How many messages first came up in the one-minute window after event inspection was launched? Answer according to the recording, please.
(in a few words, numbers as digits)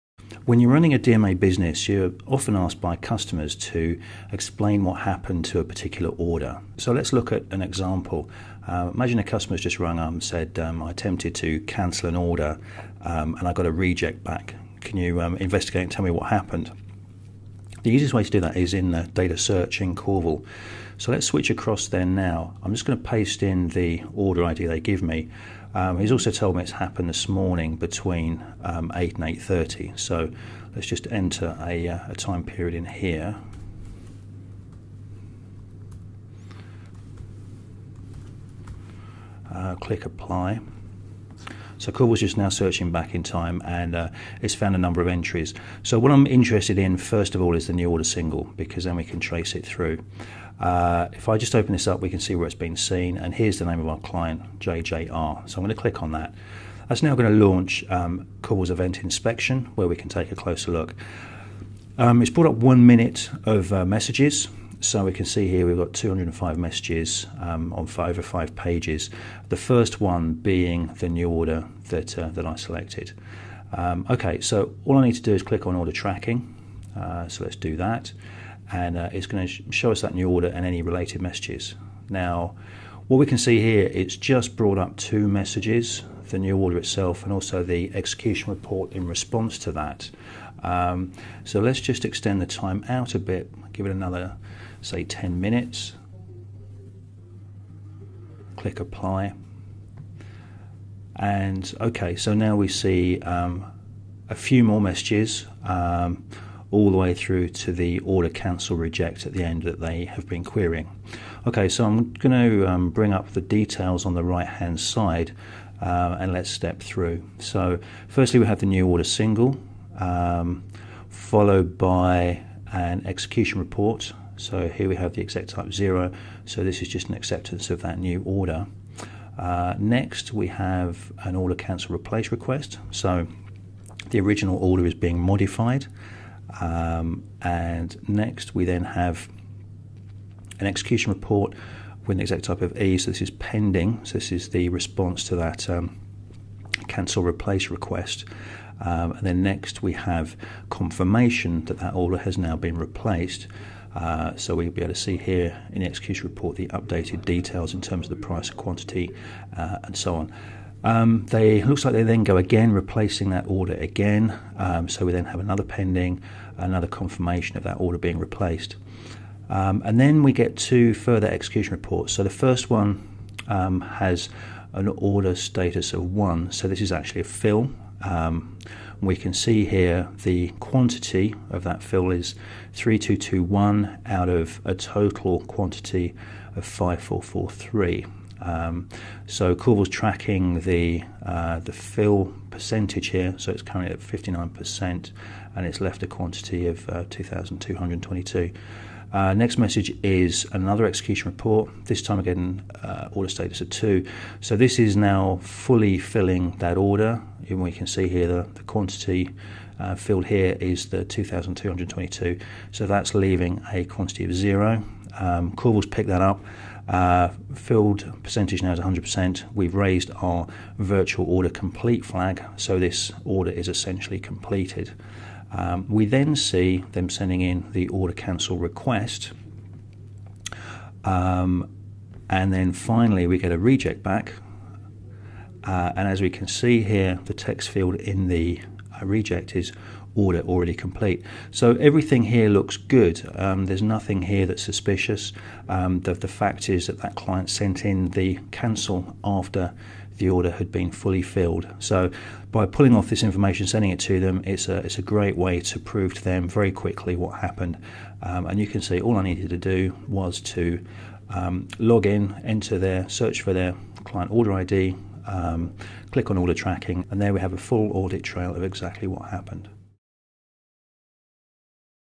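205.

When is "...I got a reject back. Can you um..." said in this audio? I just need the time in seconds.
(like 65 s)
13 s.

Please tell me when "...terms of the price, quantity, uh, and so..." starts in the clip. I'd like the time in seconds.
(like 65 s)
157 s.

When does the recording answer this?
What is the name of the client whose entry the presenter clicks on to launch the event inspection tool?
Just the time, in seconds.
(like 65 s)
54 s.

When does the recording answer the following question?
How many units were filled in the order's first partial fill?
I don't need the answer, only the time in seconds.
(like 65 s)
182 s.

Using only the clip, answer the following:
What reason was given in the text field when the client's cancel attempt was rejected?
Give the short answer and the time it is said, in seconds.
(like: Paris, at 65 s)
Order already complete, at 240 s.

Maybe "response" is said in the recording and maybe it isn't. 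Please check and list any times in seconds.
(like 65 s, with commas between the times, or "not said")
89 s, 144 s.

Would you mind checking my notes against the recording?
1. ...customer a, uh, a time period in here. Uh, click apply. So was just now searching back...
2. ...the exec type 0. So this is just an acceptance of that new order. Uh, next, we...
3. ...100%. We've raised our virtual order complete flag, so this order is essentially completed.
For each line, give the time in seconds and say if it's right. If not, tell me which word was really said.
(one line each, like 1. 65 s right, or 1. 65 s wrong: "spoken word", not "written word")
1. 31 s wrong: "enter", not "customer"
2. 125 s right
3. 218 s right.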